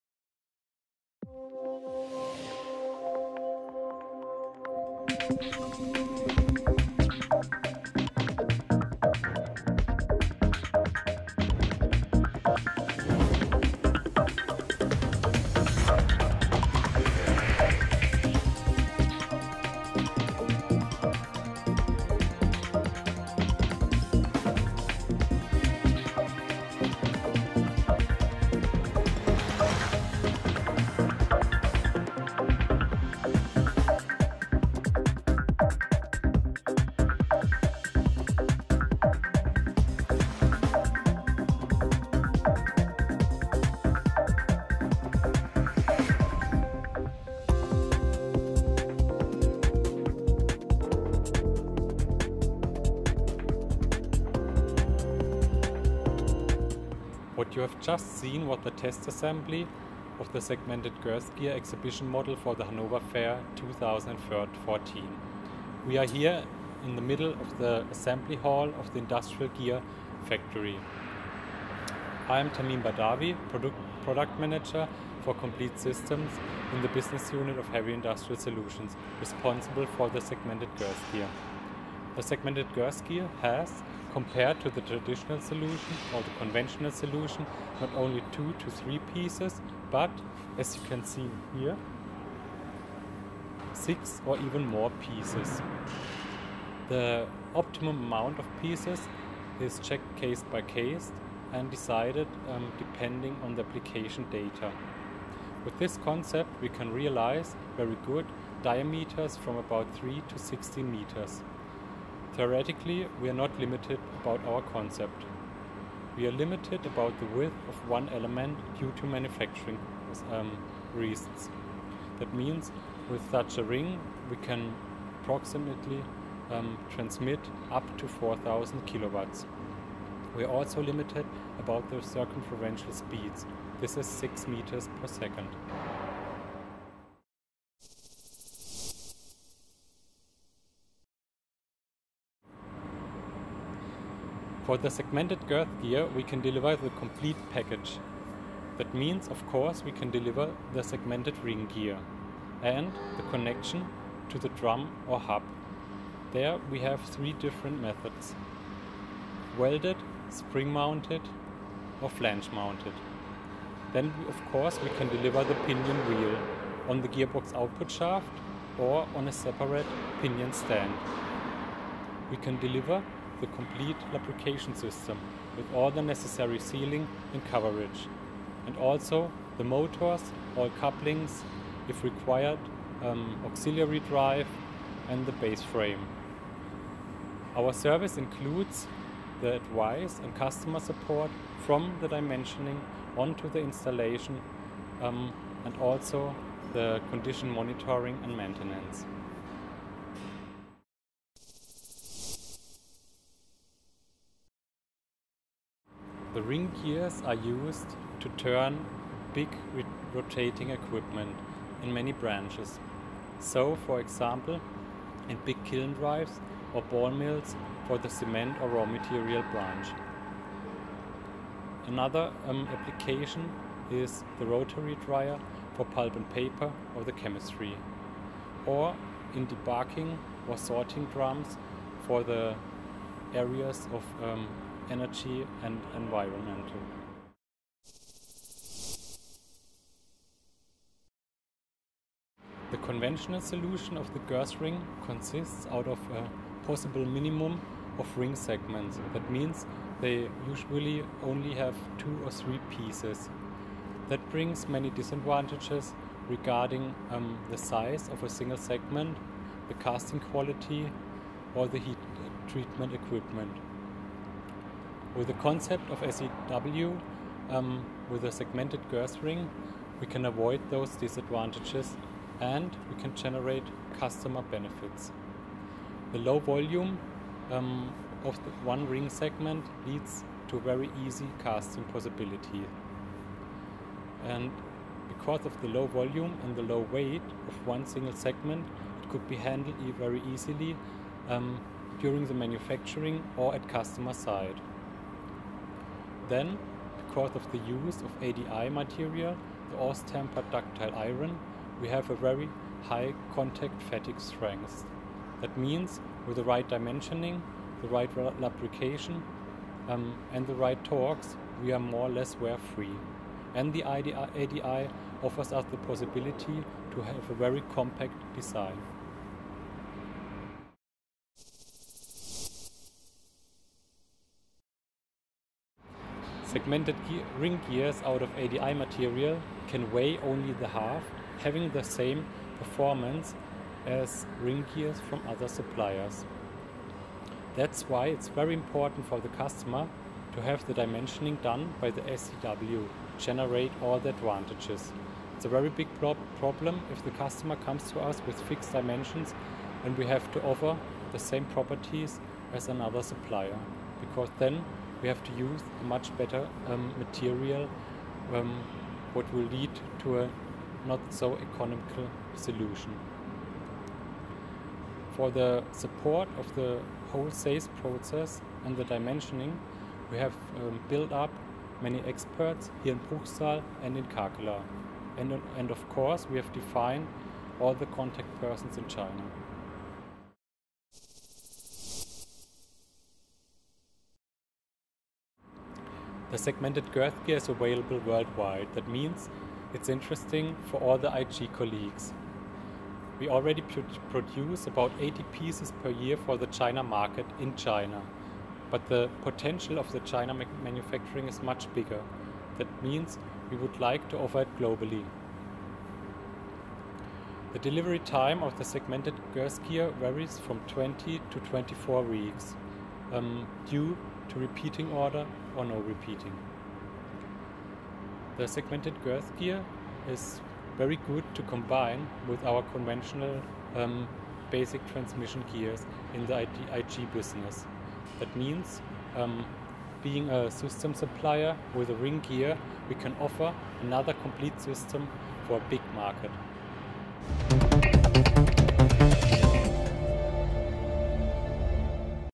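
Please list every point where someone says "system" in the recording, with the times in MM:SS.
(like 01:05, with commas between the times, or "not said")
01:15, 02:54, 07:10, 07:14.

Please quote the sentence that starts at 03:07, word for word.
Our service includes the advice and customer support from the dimensioning onto the installation um, and also the condition monitoring and maintenance.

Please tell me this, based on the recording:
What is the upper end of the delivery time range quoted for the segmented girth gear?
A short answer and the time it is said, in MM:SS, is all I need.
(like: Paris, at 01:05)
24 weeks, at 06:51.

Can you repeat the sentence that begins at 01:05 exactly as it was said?
We are here in the middle of the assembly hall of the Industrial Gear Factory.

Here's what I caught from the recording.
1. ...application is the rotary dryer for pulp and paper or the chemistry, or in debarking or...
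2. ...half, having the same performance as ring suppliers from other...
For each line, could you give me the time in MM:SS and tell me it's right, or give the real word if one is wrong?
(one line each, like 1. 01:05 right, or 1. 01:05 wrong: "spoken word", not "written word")
1. 03:42 right
2. 05:30 wrong: "gears", not "suppliers".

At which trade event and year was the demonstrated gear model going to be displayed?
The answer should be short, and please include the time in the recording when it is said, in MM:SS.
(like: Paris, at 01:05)
Hanover Fair 2014, at 01:02.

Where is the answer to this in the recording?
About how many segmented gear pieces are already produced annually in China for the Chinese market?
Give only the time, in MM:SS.
06:34.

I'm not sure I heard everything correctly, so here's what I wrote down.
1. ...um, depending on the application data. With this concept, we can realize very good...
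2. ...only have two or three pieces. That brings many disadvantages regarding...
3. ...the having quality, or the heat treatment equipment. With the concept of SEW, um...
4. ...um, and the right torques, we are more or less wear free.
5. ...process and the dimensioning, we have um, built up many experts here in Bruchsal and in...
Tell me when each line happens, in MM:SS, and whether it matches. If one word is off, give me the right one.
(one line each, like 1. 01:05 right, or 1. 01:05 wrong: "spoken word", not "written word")
1. 01:42 right
2. 04:11 right
3. 04:19 wrong: "casting", not "having"
4. 05:09 right
5. 06:07 right.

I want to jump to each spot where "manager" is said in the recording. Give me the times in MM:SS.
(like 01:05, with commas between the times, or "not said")
01:14.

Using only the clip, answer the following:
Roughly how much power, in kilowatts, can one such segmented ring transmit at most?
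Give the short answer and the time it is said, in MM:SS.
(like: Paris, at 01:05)
4000 kilowatts, at 02:08.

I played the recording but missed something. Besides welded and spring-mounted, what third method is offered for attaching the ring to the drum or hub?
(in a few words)
Flange-mounted.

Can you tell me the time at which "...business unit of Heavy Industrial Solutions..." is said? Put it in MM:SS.
01:16.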